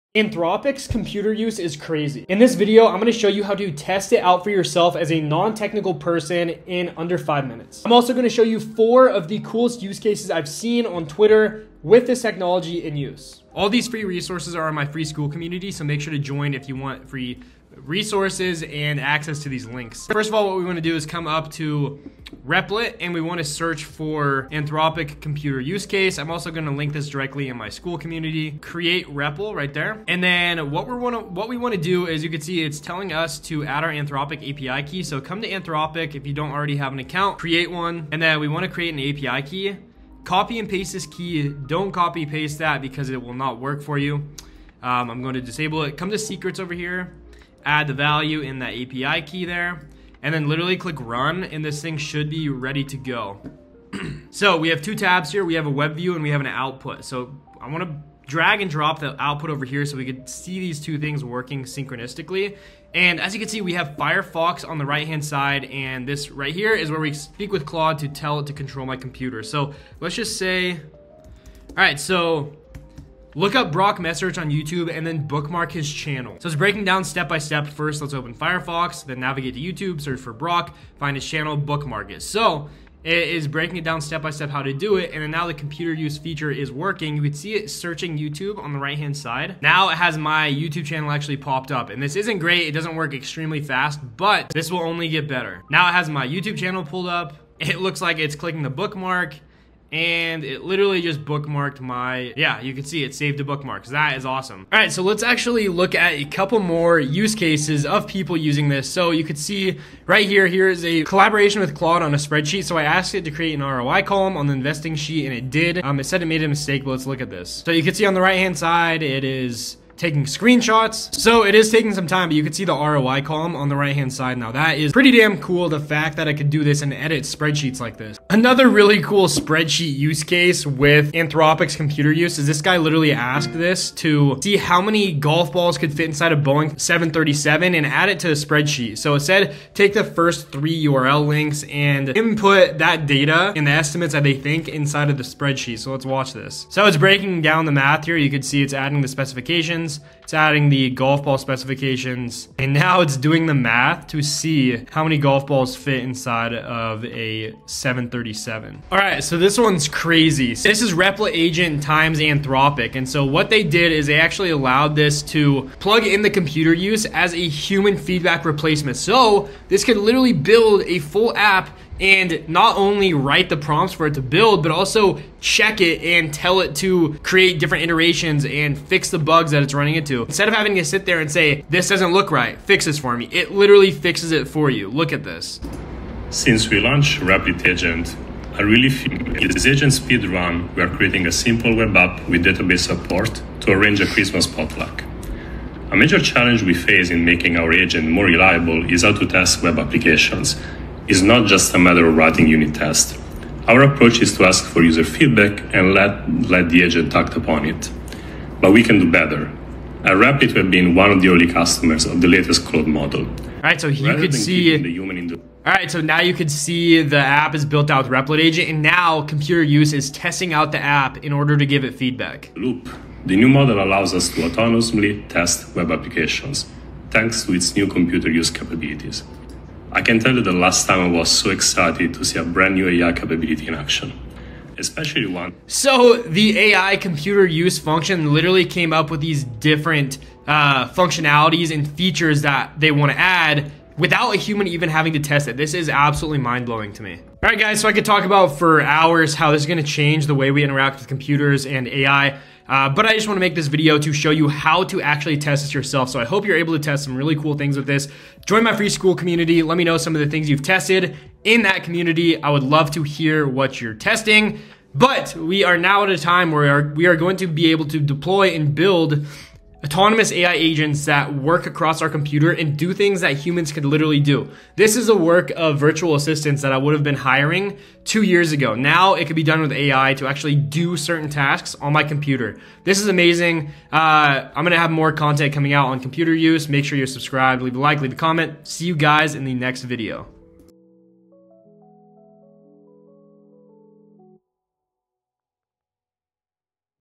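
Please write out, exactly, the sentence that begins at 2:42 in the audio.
And so what they did is they actually allowed this to plug in the computer use as a human feedback replacement.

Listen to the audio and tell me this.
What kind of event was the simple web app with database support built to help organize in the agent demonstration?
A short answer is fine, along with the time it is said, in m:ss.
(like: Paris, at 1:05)
Christmas potluck, at 3:14.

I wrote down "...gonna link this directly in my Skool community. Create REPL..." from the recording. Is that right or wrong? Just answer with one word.
right.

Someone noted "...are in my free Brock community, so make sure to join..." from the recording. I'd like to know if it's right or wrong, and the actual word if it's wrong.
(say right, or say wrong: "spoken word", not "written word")
wrong: "Skool", not "Brock".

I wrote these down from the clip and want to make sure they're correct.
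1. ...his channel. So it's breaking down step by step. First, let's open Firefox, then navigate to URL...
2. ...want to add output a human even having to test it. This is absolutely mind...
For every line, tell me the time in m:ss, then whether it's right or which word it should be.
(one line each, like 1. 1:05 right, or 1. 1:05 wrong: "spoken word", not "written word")
1. 1:15 wrong: "YouTube", not "URL"
2. 4:02 wrong: "without", not "output".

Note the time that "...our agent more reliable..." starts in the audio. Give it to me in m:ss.
3:17.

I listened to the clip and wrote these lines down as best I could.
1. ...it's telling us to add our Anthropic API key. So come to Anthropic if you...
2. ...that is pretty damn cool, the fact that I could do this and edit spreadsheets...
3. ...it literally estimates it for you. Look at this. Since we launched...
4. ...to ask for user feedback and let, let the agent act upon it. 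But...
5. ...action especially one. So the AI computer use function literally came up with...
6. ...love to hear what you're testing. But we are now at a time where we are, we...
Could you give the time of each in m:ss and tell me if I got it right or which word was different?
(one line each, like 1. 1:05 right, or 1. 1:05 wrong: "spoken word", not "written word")
1. 0:32 right
2. 2:04 right
3. 3:03 wrong: "fixes", not "estimates"
4. 3:24 right
5. 3:53 right
6. 4:22 right.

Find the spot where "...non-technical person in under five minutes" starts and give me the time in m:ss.
0:05.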